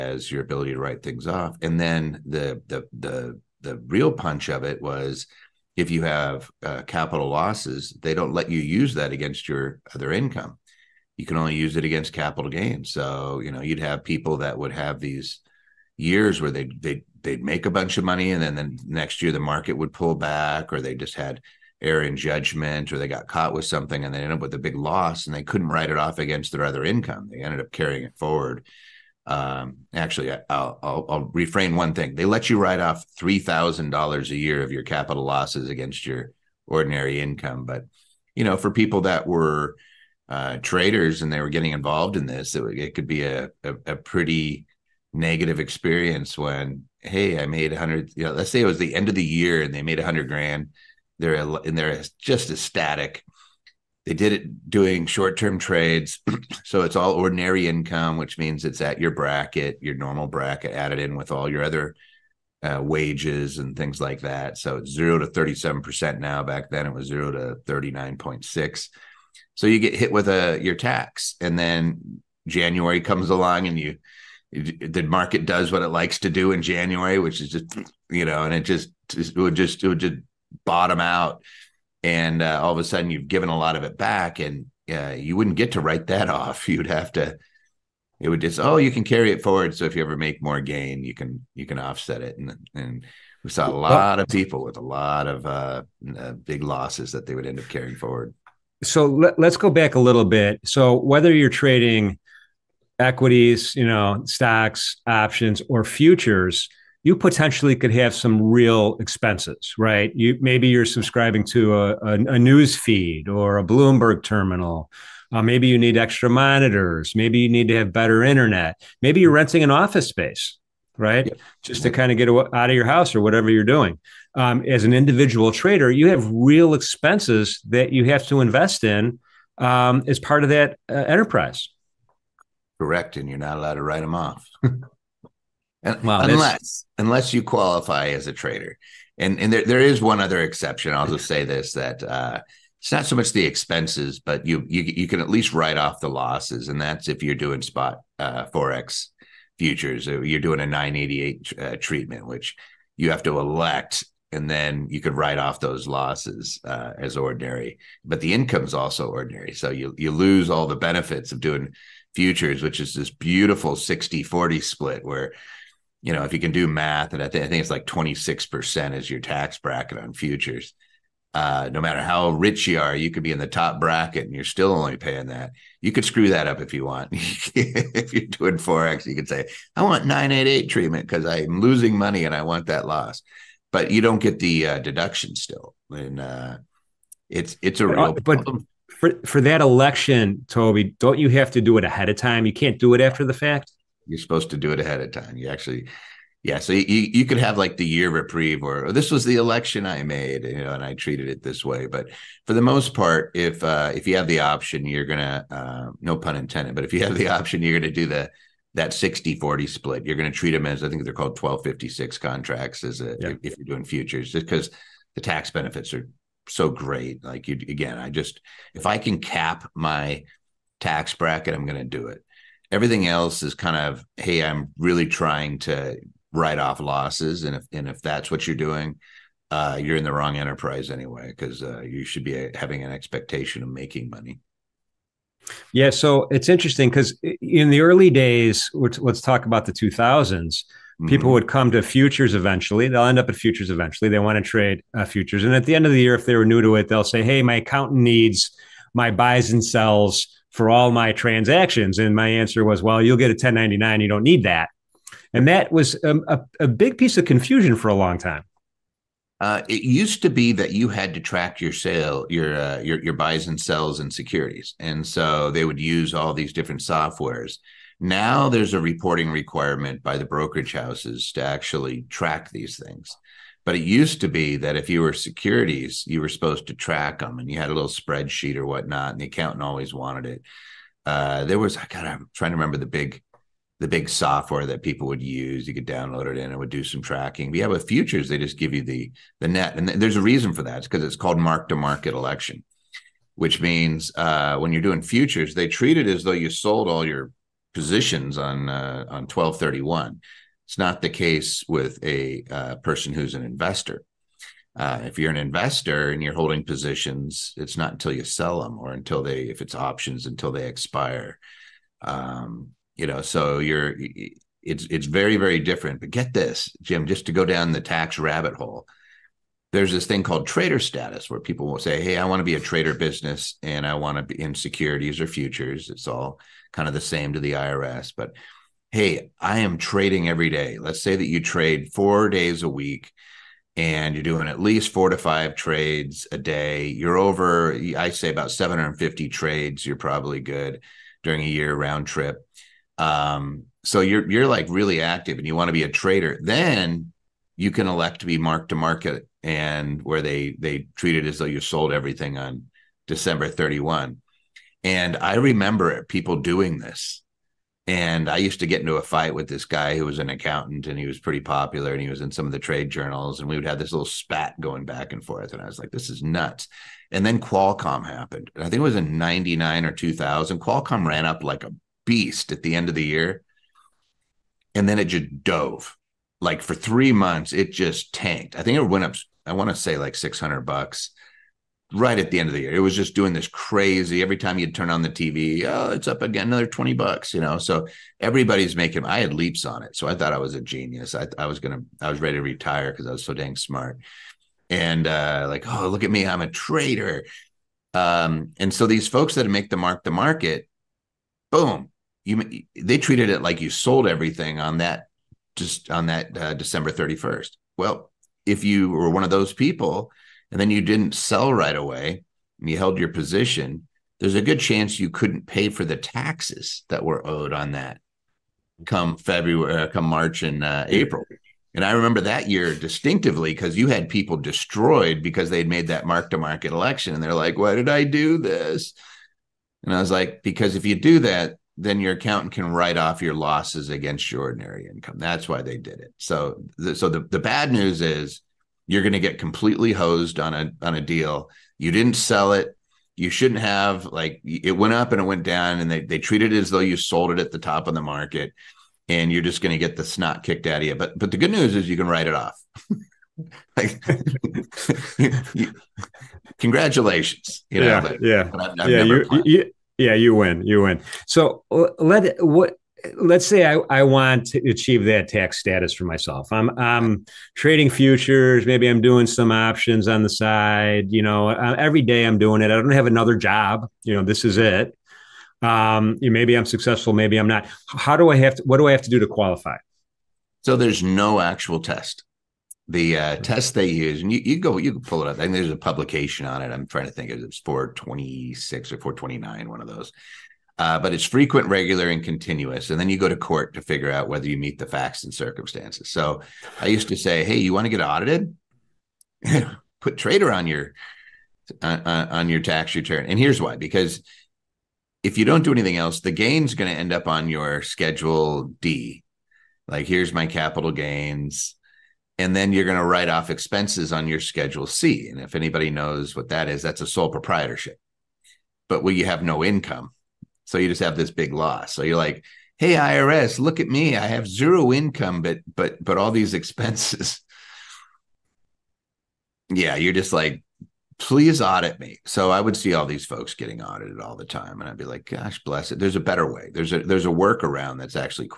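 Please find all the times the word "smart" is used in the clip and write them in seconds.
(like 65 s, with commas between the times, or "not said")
393 s.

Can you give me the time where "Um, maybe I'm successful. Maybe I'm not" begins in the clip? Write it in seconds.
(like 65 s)
475 s.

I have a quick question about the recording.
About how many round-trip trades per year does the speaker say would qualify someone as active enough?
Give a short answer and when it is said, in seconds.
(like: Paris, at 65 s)
750, at 338 s.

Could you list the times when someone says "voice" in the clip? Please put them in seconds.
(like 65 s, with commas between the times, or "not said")
not said.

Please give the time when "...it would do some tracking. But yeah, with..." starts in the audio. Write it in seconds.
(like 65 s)
286 s.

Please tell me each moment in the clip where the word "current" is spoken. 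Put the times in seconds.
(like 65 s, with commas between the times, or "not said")
not said.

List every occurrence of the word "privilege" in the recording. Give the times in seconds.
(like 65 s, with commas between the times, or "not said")
not said.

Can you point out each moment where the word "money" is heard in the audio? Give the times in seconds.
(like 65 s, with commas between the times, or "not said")
18 s, 181 s, 234 s.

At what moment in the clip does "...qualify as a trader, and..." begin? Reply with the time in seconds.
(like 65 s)
137 s.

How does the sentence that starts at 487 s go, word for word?
It was 426 or 429, one of those uh, but it's frequent, regular, and continuous.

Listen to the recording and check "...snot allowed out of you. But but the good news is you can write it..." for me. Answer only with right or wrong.
wrong.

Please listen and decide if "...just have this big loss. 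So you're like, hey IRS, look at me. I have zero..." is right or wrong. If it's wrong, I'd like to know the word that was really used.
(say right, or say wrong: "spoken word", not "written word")
right.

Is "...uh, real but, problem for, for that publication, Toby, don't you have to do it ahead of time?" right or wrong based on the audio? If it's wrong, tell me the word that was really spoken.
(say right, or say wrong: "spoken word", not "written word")
wrong: "election", not "publication".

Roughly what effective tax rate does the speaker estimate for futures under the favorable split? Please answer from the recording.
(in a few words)
26%.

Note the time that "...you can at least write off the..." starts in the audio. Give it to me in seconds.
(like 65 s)
144 s.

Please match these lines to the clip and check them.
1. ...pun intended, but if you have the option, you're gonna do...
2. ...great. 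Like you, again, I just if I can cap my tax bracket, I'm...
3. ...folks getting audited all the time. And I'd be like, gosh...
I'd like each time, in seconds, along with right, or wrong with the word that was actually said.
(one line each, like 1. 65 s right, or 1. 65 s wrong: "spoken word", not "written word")
1. 206 s right
2. 216 s right
3. 533 s right.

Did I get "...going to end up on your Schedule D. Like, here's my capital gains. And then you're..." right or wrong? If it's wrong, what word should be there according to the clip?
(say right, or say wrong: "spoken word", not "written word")
right.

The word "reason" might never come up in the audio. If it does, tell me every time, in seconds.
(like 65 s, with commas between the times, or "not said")
290 s.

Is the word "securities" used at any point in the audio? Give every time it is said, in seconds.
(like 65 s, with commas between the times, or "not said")
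264 s, 275 s, 324 s.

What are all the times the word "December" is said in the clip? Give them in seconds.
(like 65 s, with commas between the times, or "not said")
353 s, 406 s.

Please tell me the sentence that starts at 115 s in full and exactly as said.
Uh, maybe you need extra monitors.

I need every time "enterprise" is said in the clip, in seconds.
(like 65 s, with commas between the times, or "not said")
130 s, 230 s.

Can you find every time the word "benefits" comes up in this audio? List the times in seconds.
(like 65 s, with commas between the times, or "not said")
160 s, 215 s.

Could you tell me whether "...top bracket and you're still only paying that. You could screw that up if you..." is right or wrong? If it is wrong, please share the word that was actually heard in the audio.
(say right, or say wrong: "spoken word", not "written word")
right.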